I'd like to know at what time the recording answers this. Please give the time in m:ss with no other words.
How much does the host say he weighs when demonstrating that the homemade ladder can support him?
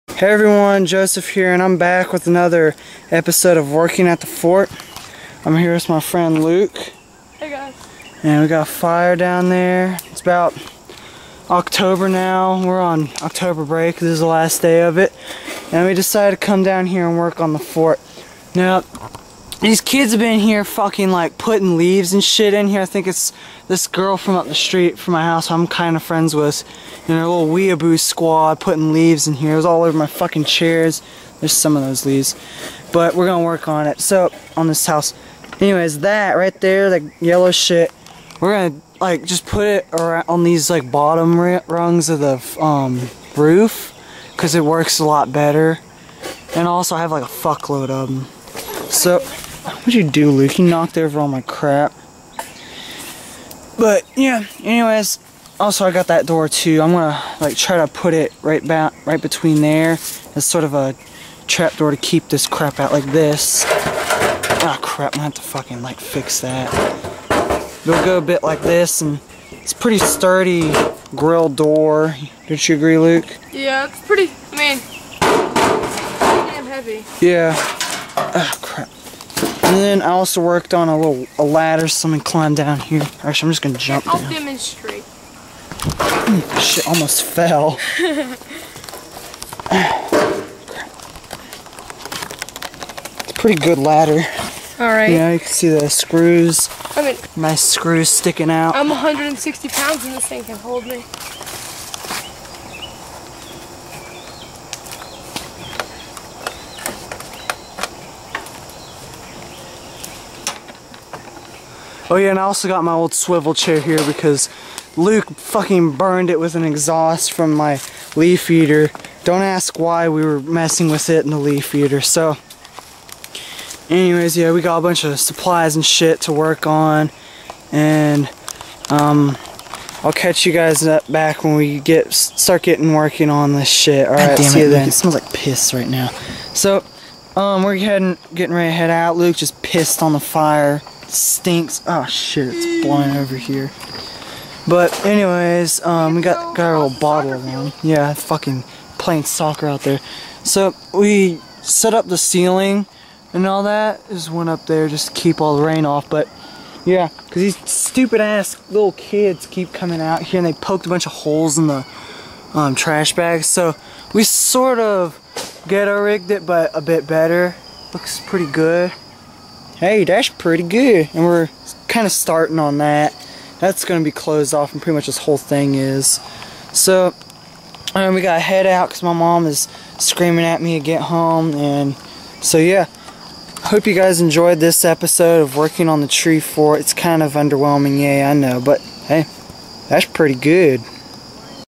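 1:38.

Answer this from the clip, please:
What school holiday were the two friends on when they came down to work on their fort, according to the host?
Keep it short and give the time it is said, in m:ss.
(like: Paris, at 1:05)
October break, at 0:13.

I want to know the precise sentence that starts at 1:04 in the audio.
Ah crap, I'm gonna have to fucking like fix that.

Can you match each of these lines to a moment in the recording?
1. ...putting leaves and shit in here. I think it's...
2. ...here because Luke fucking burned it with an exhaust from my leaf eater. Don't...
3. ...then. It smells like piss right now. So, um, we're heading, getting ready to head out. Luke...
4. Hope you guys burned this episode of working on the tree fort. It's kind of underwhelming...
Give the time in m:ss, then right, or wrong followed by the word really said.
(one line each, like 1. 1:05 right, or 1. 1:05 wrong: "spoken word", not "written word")
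1. 0:21 right
2. 1:53 right
3. 2:14 right
4. 3:03 wrong: "enjoyed", not "burned".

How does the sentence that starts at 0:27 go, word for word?
know, a little weeaboo squad putting leaves in here.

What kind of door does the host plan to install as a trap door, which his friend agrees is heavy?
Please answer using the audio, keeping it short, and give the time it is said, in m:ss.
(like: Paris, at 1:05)
grill door, at 1:11.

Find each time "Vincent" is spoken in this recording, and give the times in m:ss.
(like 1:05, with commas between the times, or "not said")
not said.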